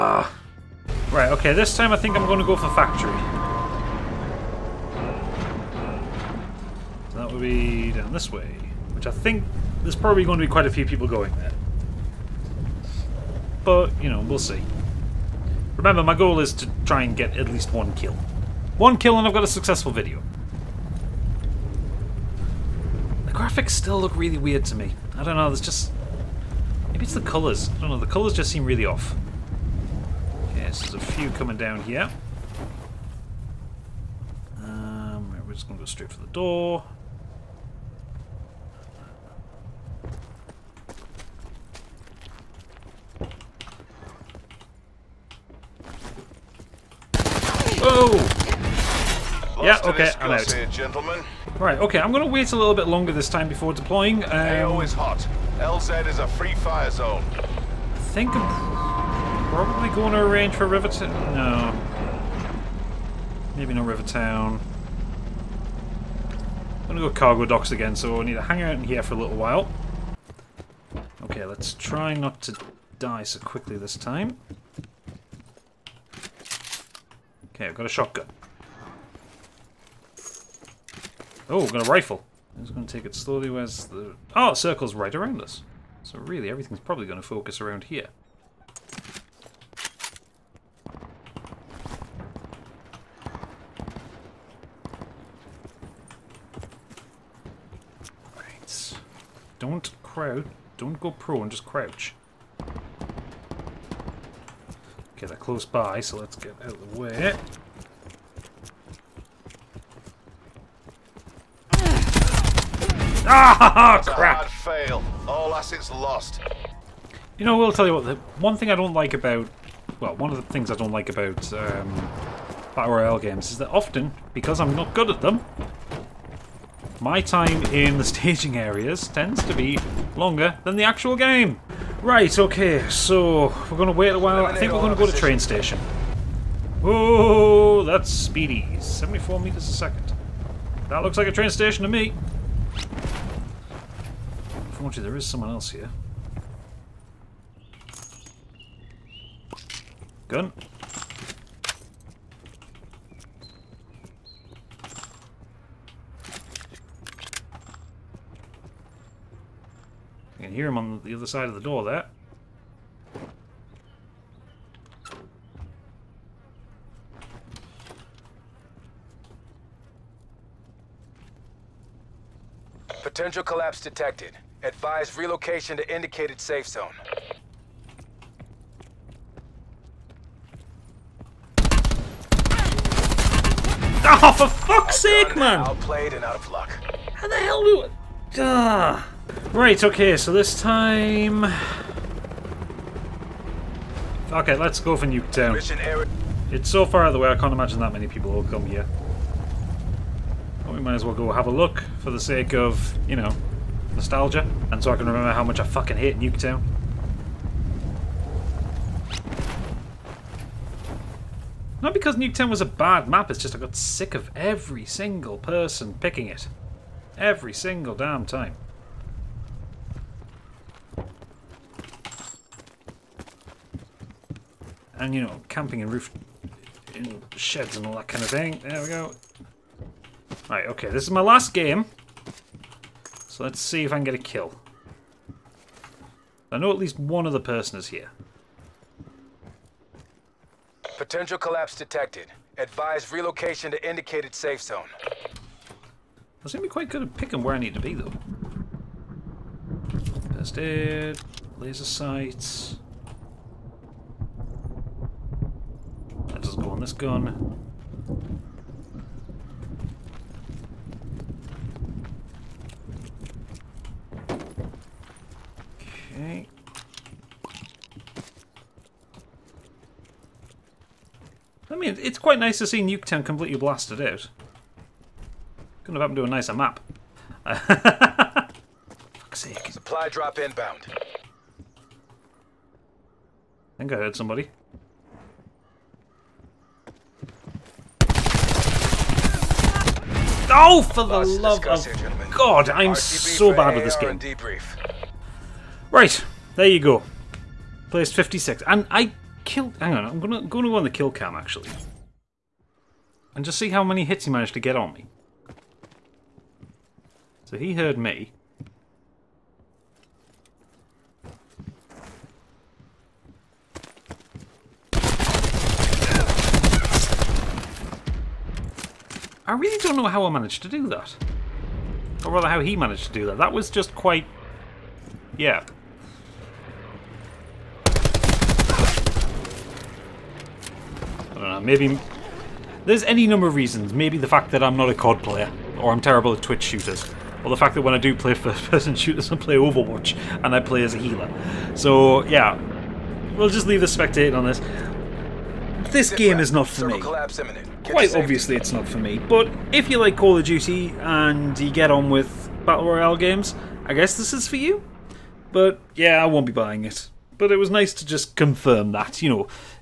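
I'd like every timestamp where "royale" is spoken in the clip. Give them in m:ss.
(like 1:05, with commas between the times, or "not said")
2:02, 5:52.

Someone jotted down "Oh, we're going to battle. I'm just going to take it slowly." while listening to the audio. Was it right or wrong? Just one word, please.
wrong.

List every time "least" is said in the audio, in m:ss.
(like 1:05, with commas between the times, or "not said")
0:17, 3:56.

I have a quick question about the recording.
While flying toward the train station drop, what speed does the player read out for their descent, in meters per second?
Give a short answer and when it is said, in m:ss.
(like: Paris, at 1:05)
74, at 2:18.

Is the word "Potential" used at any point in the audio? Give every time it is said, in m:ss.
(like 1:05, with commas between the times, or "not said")
2:53, 4:00.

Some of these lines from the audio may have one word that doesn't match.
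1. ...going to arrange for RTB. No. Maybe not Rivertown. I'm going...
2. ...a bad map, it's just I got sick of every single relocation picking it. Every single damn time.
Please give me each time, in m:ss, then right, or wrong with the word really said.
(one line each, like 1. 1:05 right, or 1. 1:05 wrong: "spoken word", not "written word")
1. 0:59 wrong: "Rivertown", not "RTB"
2. 3:32 wrong: "person", not "relocation".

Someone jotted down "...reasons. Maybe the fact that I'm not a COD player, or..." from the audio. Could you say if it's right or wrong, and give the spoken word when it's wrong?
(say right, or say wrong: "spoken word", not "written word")
right.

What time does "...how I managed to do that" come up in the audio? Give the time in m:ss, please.
5:20.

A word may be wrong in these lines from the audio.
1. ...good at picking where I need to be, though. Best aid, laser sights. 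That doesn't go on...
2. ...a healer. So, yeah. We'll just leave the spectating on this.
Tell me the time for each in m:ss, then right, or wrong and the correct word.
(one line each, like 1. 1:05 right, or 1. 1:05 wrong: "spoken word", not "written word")
1. 4:06 right
2. 5:40 right.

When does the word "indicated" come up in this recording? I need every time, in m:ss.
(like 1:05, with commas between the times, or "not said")
2:55, 4:03.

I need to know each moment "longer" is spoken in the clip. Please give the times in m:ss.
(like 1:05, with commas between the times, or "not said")
0:52, 2:10.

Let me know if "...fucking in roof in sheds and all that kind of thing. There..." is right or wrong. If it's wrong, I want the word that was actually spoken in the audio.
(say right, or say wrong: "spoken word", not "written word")
wrong: "camping", not "fucking".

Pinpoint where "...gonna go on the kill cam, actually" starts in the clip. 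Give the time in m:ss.
5:00.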